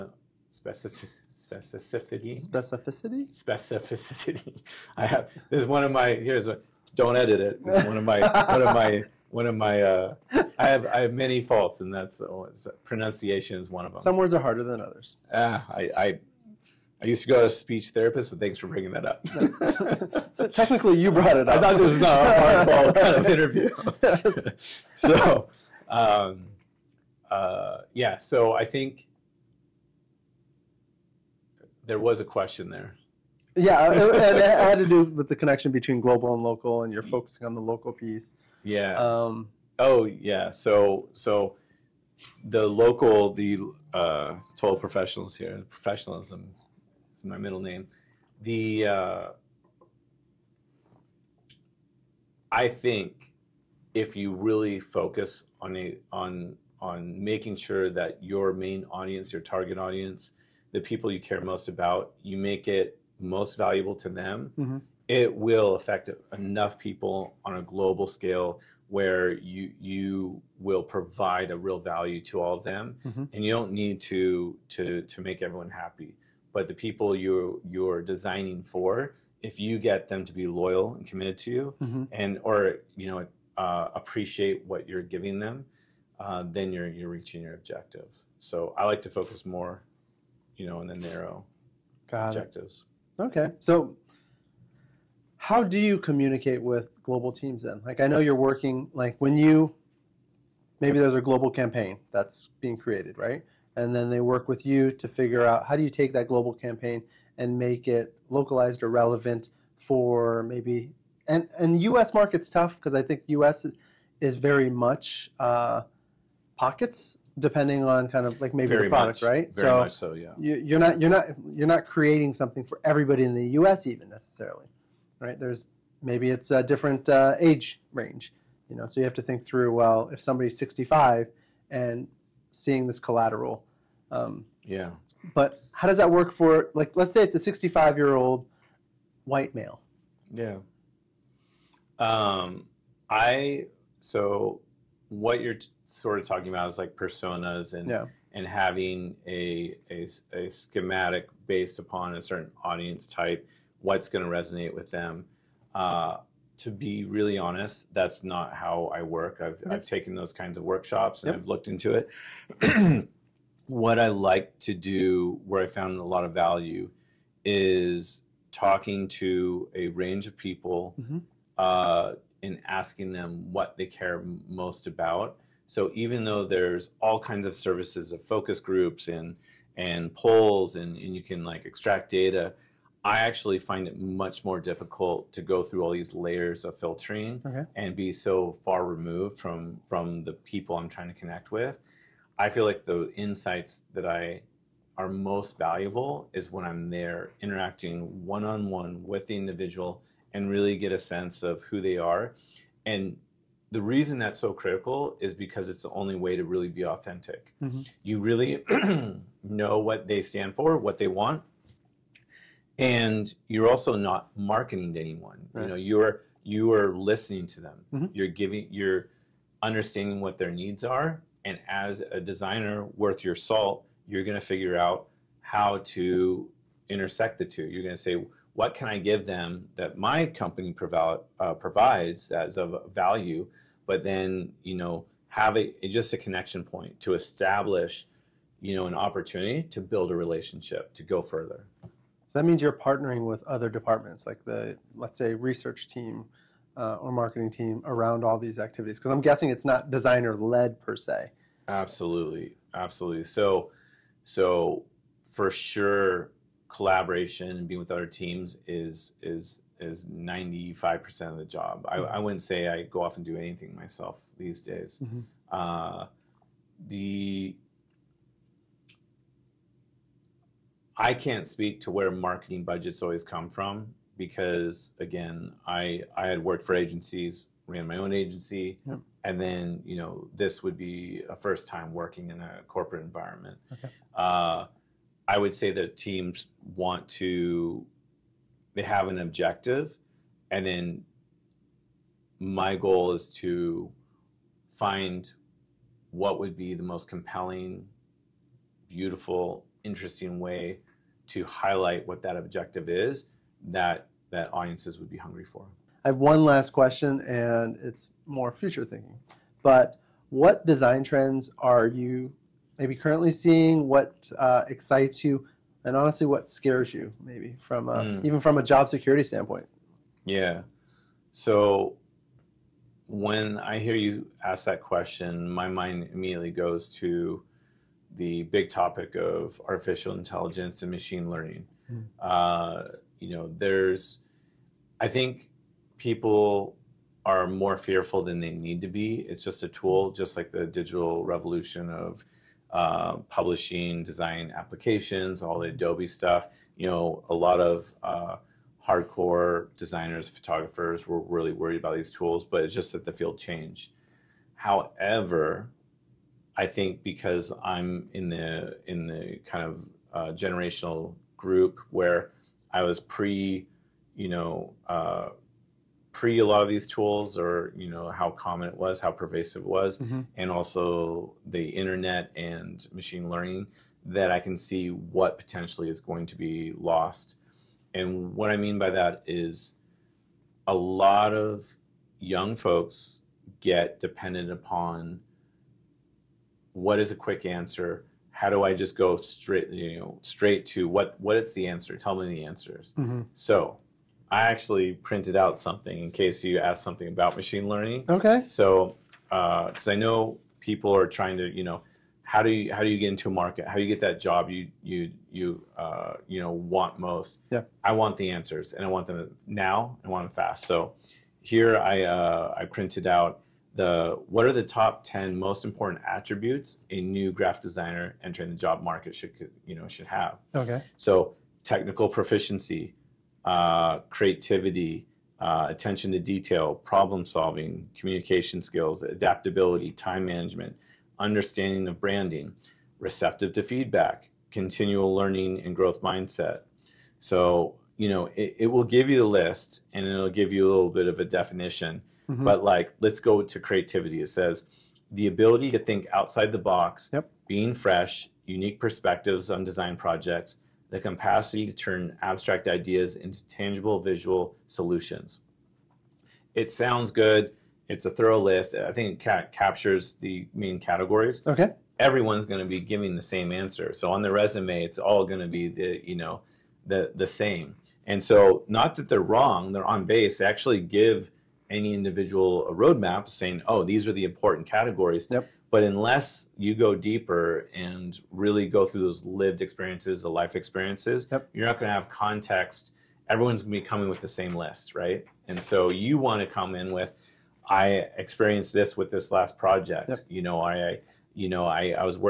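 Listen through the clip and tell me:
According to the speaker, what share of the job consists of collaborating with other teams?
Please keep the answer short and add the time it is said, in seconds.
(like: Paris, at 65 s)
95%, at 260 s.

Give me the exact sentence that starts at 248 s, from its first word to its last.
Because I'm guessing it's not designer led per se.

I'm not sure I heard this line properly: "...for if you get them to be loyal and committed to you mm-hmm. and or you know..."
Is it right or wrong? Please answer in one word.
right.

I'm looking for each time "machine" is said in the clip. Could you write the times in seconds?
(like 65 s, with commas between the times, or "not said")
330 s, 372 s, 397 s.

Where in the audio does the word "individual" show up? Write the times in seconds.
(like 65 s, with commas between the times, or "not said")
199 s, 471 s.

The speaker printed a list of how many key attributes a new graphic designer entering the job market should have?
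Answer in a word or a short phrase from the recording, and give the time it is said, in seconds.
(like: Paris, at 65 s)
10, at 415 s.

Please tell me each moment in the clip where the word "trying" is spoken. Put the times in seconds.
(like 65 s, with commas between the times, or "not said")
190 s, 401 s.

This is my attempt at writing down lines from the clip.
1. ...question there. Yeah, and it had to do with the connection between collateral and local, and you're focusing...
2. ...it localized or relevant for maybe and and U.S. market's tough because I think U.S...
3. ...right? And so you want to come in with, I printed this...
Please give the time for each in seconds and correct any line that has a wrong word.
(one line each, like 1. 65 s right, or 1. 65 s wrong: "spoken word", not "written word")
1. 32 s wrong: "global", not "collateral"
2. 107 s right
3. 484 s wrong: "experienced", not "printed".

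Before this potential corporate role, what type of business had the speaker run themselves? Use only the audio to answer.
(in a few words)
agency.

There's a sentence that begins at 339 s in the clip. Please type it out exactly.
It's just a tool, just like the digital revolution of uh, publishing, design applications, all the Adobe stuff.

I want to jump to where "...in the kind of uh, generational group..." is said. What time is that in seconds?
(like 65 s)
358 s.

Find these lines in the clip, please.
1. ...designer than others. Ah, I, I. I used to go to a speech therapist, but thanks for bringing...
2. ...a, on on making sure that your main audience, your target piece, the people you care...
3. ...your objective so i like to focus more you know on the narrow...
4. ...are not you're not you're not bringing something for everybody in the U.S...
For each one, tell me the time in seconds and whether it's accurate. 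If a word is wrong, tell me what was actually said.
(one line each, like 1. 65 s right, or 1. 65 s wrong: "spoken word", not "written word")
1. 14 s wrong: "harder", not "designer"
2. 55 s wrong: "audience", not "piece"
3. 87 s right
4. 120 s wrong: "creating", not "bringing".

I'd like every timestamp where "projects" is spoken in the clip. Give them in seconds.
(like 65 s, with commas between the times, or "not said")
449 s, 489 s.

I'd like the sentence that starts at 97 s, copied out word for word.
Like I know you're working like when you maybe there's a global campaign that's being created, right?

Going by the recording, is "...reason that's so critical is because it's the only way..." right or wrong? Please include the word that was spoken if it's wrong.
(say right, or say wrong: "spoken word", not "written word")
right.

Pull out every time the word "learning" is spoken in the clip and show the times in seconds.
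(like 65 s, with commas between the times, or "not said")
331 s, 373 s, 397 s, 435 s.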